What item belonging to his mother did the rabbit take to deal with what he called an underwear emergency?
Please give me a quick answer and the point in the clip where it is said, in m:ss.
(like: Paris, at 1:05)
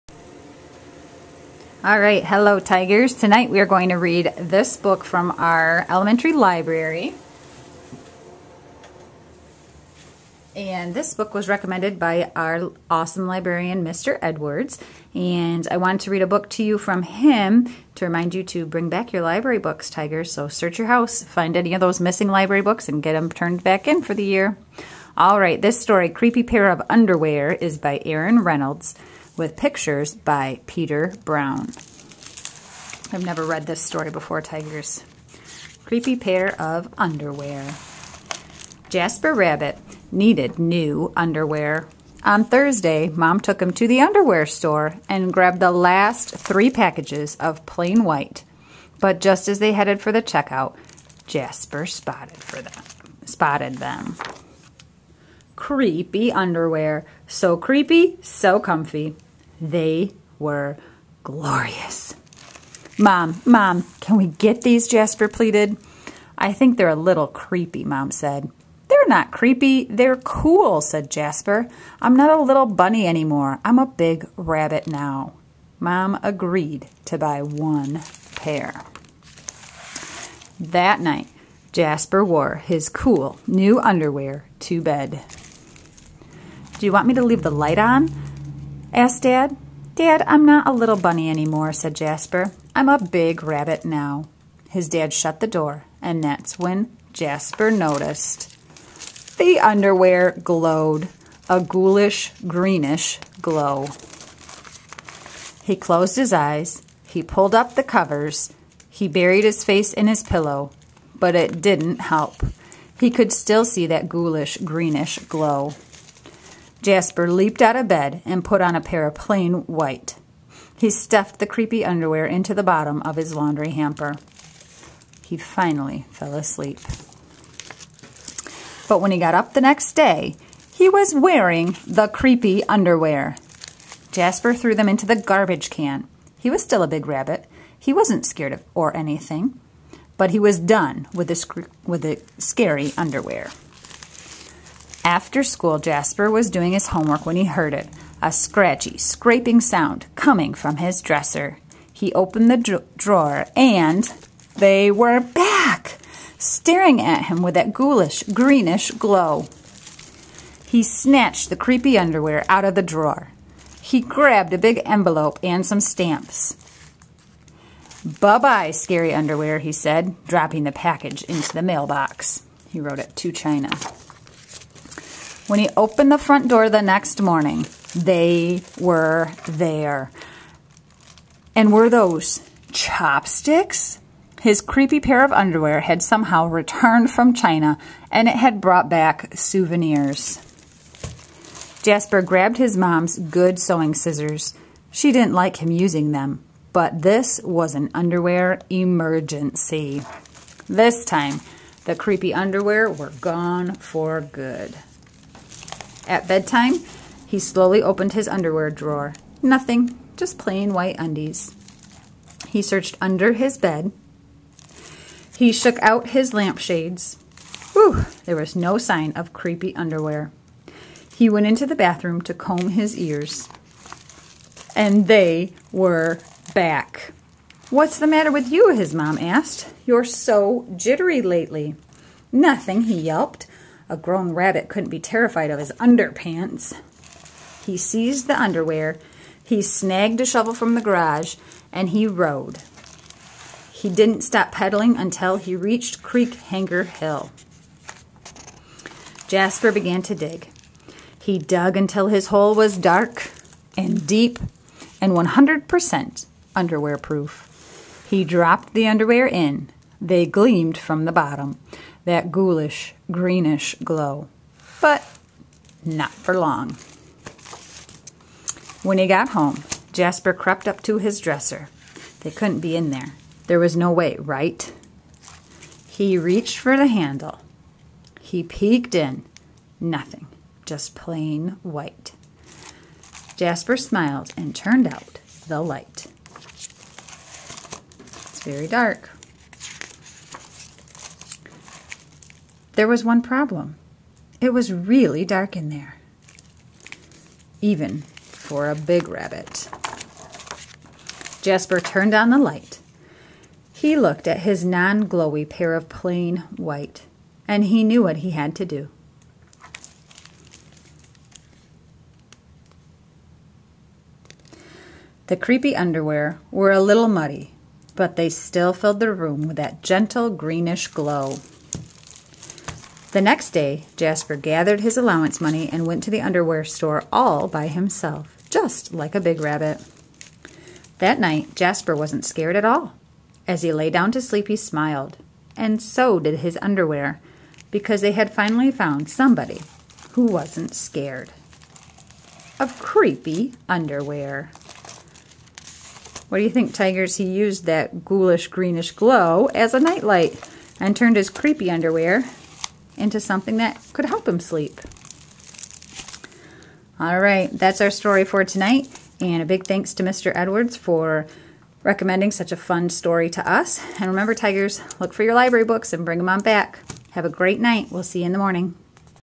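good sewing scissors, at 3:13.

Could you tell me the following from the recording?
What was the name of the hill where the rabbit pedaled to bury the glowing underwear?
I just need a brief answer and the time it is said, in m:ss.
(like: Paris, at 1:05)
Crackenhopper Hill, at 4:06.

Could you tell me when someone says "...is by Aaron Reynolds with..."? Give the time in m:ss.
0:27.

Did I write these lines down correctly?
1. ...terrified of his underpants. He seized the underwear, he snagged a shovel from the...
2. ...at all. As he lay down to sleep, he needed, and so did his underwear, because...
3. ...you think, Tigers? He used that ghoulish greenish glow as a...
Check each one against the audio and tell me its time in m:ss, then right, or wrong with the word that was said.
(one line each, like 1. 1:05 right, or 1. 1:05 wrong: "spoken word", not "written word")
1. 3:55 right
2. 5:32 wrong: "smiled", not "needed"
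3. 5:46 right.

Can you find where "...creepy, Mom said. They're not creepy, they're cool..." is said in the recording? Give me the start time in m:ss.
1:07.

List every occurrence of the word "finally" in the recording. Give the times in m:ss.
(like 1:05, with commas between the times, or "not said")
2:05, 5:38.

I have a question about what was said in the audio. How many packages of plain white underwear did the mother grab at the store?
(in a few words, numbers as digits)
3.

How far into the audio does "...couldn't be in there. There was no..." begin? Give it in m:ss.
4:32.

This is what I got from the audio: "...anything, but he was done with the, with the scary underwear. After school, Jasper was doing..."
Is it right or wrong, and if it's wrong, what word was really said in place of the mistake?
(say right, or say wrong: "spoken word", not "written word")
right.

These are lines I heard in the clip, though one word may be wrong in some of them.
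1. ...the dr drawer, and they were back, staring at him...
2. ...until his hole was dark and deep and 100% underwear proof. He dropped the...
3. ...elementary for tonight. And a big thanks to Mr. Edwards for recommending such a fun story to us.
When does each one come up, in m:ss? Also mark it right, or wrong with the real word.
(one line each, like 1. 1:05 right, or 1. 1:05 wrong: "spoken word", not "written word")
1. 2:32 right
2. 4:11 right
3. 5:57 wrong: "story", not "elementary".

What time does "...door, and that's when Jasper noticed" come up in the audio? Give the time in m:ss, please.
1:35.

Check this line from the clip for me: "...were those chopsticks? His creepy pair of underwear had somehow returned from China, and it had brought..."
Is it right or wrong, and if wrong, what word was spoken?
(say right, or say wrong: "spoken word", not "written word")
right.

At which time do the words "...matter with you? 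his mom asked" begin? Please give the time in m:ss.
3:48.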